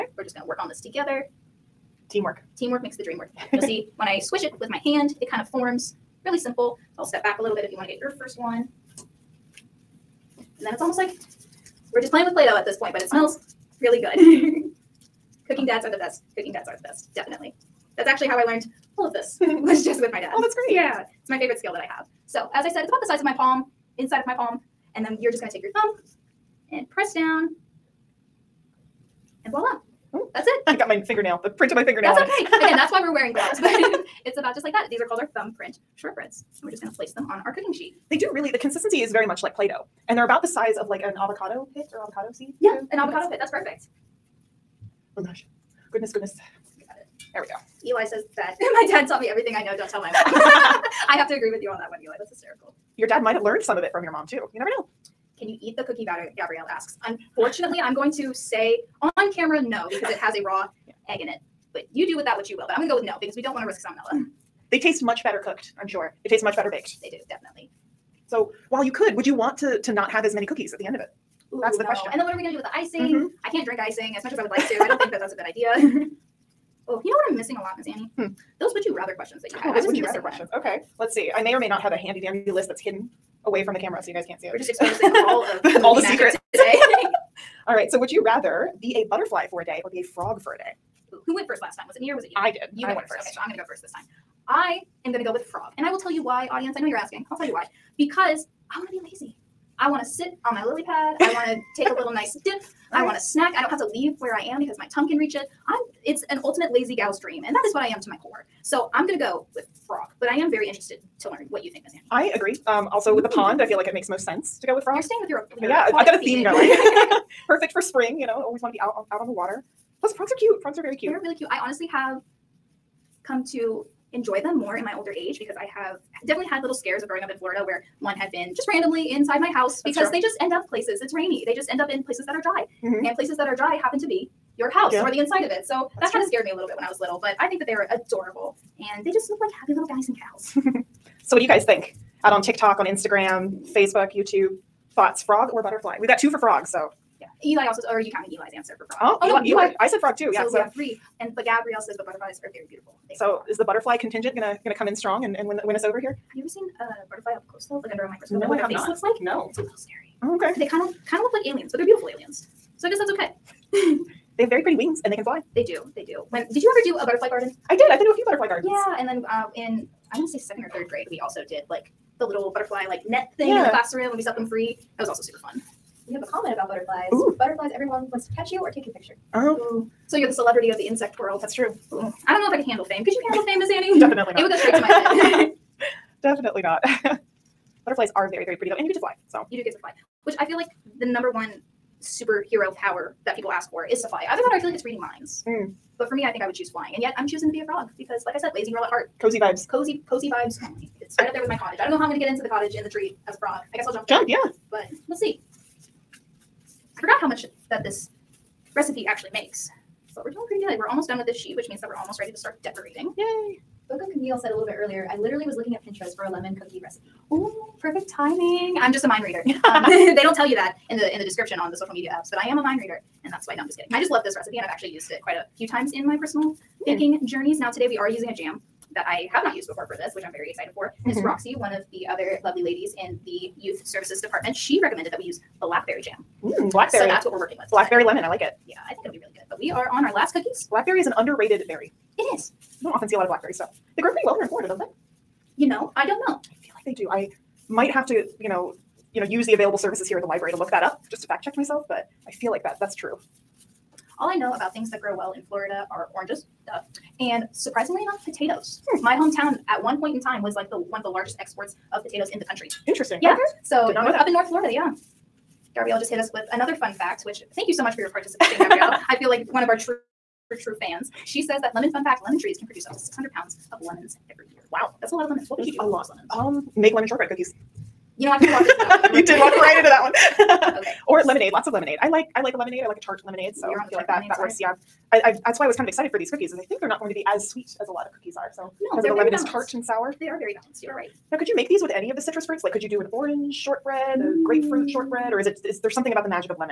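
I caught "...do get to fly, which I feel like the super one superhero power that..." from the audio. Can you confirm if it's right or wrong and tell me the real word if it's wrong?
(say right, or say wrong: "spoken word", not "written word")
wrong: "number", not "super".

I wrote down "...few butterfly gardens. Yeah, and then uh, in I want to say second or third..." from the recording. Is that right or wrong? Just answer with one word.
right.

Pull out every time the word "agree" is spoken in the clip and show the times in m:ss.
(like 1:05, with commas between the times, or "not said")
0:51, 1:52.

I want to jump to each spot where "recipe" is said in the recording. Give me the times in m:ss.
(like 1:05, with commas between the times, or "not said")
3:28, 3:36, 3:44.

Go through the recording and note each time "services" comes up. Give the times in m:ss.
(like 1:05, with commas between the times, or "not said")
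3:53, 4:09.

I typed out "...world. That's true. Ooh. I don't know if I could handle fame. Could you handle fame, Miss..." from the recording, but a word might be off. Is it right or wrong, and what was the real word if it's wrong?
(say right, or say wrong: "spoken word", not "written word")
right.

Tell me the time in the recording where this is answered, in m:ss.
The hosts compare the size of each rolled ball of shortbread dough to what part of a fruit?
0:41.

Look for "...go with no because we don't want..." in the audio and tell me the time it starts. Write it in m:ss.
1:02.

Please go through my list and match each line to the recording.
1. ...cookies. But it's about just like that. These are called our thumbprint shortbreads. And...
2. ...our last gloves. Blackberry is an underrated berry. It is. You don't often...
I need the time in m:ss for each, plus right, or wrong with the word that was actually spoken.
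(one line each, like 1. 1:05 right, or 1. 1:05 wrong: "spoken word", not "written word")
1. 0:33 wrong: "gloves", not "cookies"
2. 4:00 wrong: "cookies", not "gloves".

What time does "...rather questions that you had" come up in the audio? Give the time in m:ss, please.
1:18.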